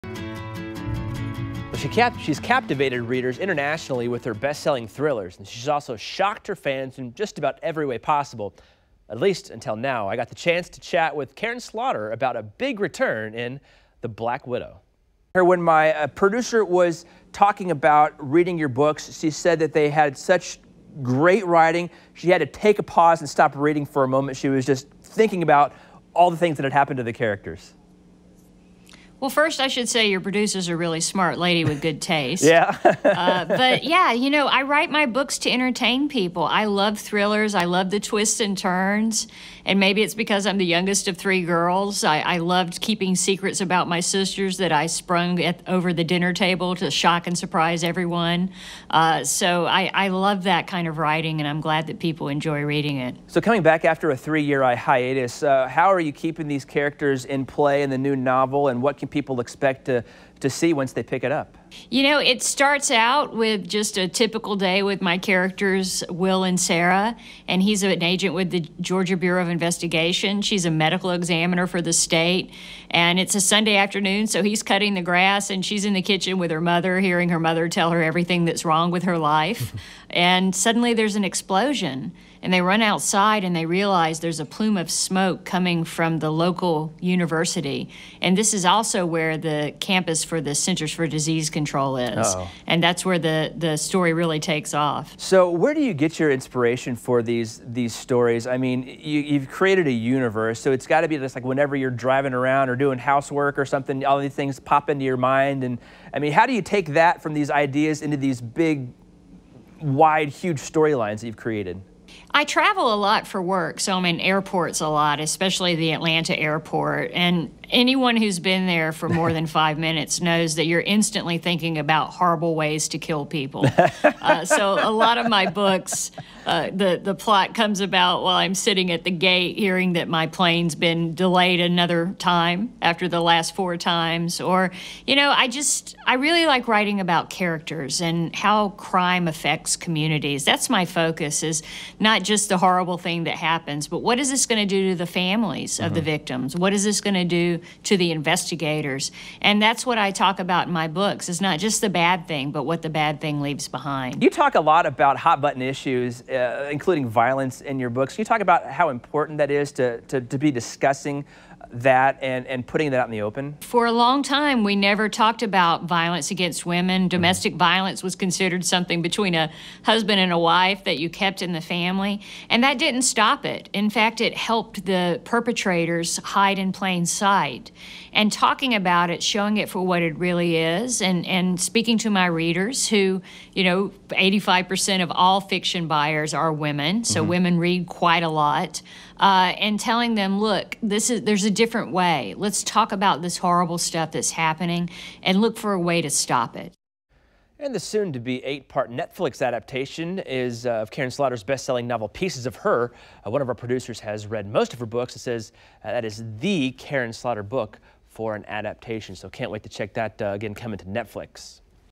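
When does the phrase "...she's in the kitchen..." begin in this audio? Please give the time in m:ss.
1:15.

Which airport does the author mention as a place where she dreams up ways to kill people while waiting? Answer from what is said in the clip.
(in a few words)
Atlanta airport.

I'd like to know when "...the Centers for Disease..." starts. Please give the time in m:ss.
1:30.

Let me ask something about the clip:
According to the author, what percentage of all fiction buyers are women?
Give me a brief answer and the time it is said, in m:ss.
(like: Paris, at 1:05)
85%, at 3:04.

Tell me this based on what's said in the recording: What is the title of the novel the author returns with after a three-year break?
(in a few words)
The Black Widow.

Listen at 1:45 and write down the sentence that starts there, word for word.
And I mean, how do you take that from these ideas into these big, wide, huge storylines that you've created?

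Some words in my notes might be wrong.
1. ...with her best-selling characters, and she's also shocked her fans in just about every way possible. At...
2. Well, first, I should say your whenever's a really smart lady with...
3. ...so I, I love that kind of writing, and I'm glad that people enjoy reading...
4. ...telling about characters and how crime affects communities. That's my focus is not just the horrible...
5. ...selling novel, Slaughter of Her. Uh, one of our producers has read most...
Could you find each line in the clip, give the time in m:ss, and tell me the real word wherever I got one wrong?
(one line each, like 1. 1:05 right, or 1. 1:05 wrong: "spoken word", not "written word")
1. 0:04 wrong: "thrillers", not "characters"
2. 0:29 wrong: "producer", not "whenever"
3. 0:49 right
4. 2:16 wrong: "writing", not "telling"
5. 3:21 wrong: "Pieces", not "Slaughter".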